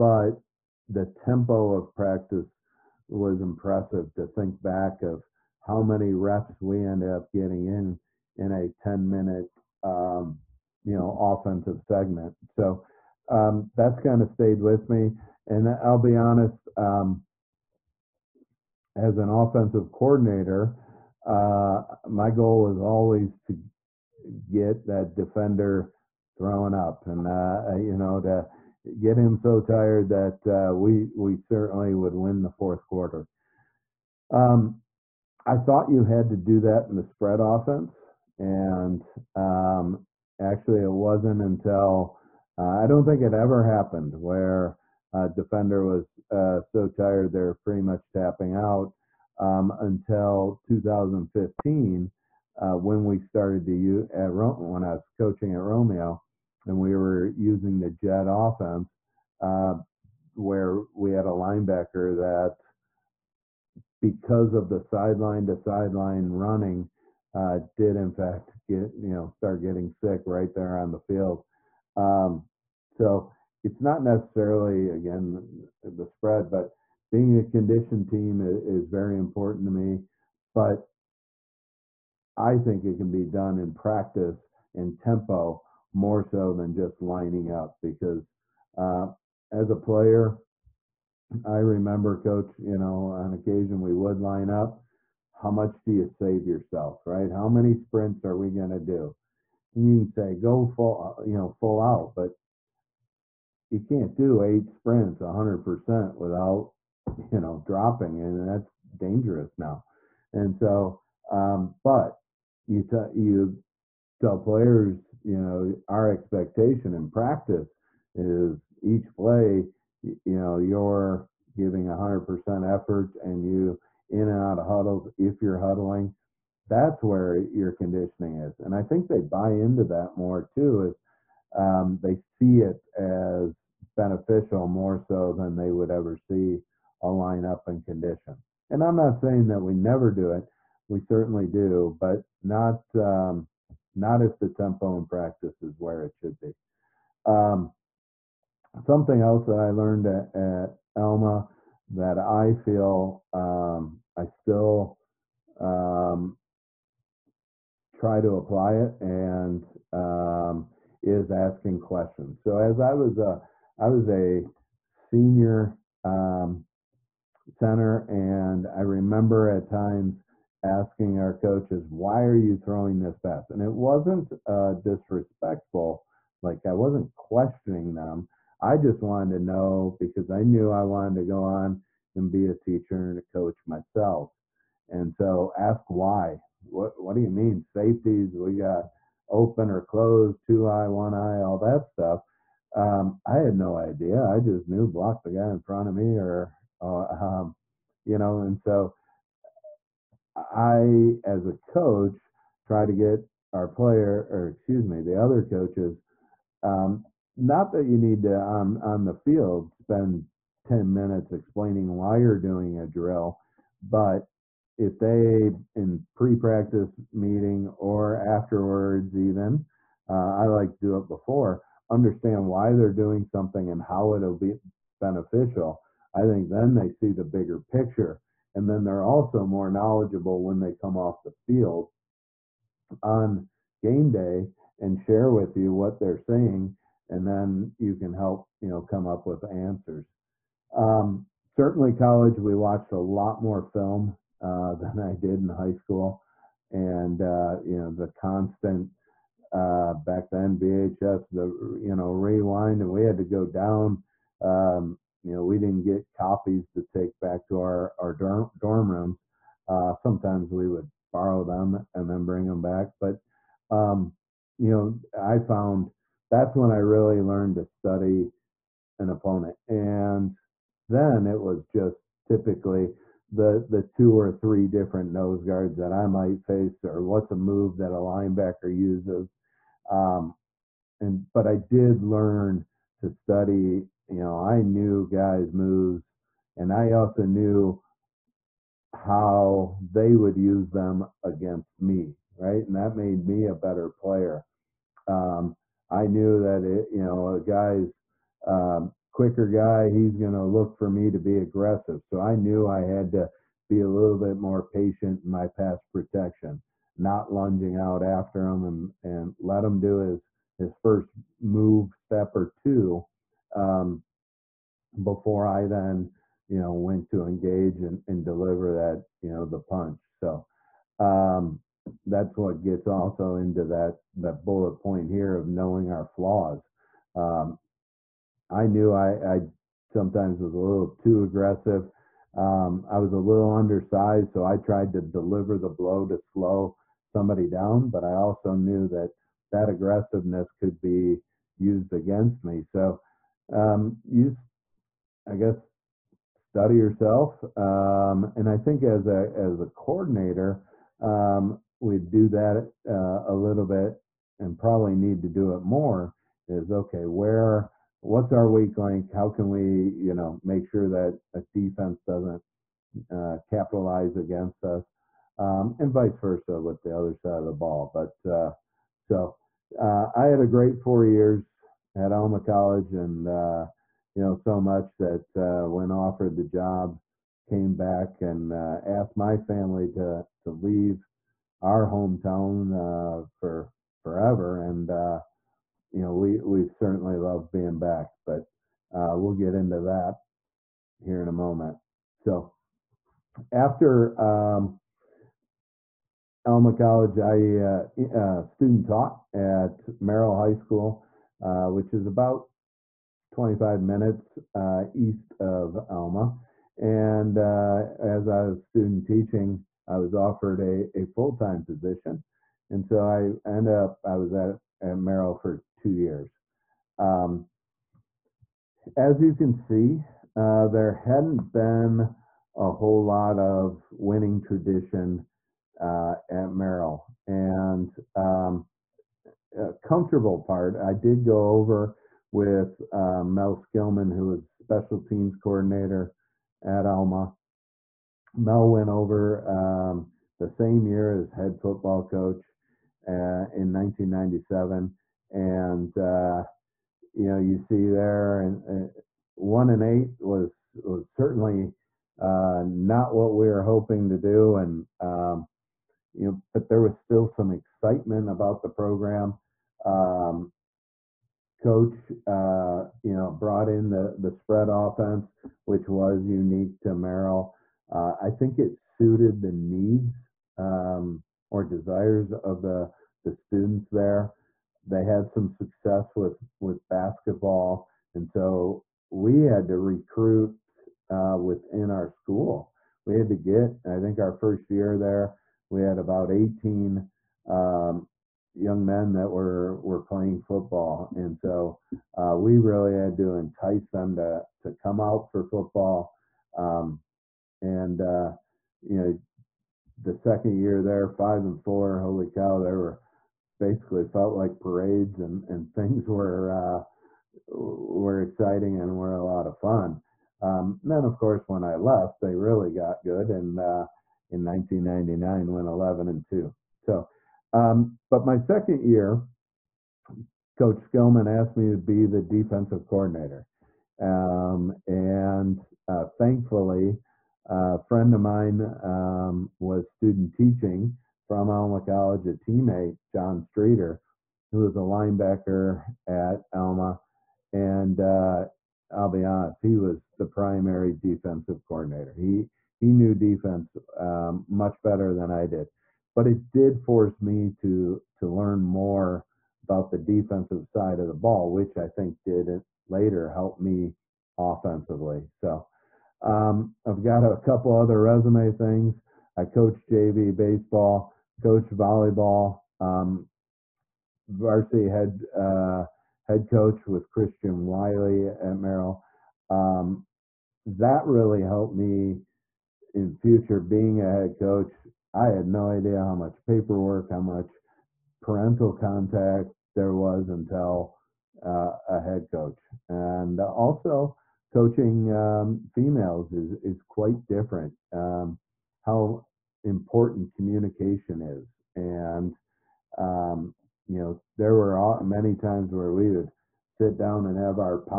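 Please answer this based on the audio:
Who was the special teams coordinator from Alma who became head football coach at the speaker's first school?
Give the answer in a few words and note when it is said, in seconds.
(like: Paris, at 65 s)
Mel Skillman, at 433 s.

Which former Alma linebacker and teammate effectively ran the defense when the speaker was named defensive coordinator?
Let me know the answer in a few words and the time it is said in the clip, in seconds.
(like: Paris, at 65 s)
John Streeter, at 533 s.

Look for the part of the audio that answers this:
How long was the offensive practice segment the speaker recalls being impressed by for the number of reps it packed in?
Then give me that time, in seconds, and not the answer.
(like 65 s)
8 s.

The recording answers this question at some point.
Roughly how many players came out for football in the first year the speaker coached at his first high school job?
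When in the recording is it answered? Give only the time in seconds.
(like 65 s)
486 s.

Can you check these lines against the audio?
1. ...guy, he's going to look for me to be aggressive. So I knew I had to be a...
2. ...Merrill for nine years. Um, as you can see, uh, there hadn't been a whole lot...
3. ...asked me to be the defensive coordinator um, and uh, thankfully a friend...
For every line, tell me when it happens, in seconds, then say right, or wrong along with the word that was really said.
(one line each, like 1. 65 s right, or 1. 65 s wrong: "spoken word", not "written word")
1. 299 s right
2. 414 s wrong: "two", not "nine"
3. 521 s right.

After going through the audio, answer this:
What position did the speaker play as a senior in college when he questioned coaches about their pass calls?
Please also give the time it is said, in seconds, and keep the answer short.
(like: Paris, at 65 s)
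center, at 167 s.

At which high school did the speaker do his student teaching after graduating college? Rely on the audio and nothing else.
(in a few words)
Merrill High School.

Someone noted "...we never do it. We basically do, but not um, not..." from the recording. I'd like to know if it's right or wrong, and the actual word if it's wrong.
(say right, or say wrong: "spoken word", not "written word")
wrong: "certainly", not "basically".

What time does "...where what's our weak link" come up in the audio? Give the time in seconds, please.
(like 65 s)
357 s.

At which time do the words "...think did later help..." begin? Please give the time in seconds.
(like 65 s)
551 s.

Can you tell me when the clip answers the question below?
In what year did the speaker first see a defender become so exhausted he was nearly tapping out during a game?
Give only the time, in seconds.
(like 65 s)
50 s.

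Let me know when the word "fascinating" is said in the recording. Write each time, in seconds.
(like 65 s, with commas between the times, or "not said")
not said.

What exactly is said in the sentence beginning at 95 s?
How much do you save yourself, right?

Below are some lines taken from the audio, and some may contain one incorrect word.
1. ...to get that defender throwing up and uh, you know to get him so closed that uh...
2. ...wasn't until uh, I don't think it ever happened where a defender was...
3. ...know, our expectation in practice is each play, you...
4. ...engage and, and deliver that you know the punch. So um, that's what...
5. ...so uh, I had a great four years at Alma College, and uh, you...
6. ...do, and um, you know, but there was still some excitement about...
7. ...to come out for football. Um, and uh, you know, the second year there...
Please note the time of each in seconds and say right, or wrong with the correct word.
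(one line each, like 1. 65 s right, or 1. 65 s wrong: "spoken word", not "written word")
1. 23 s wrong: "tired", not "closed"
2. 40 s right
3. 115 s right
4. 317 s right
5. 368 s right
6. 454 s right
7. 494 s right.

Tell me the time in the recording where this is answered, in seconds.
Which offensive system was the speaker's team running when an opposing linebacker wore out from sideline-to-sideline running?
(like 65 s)
57 s.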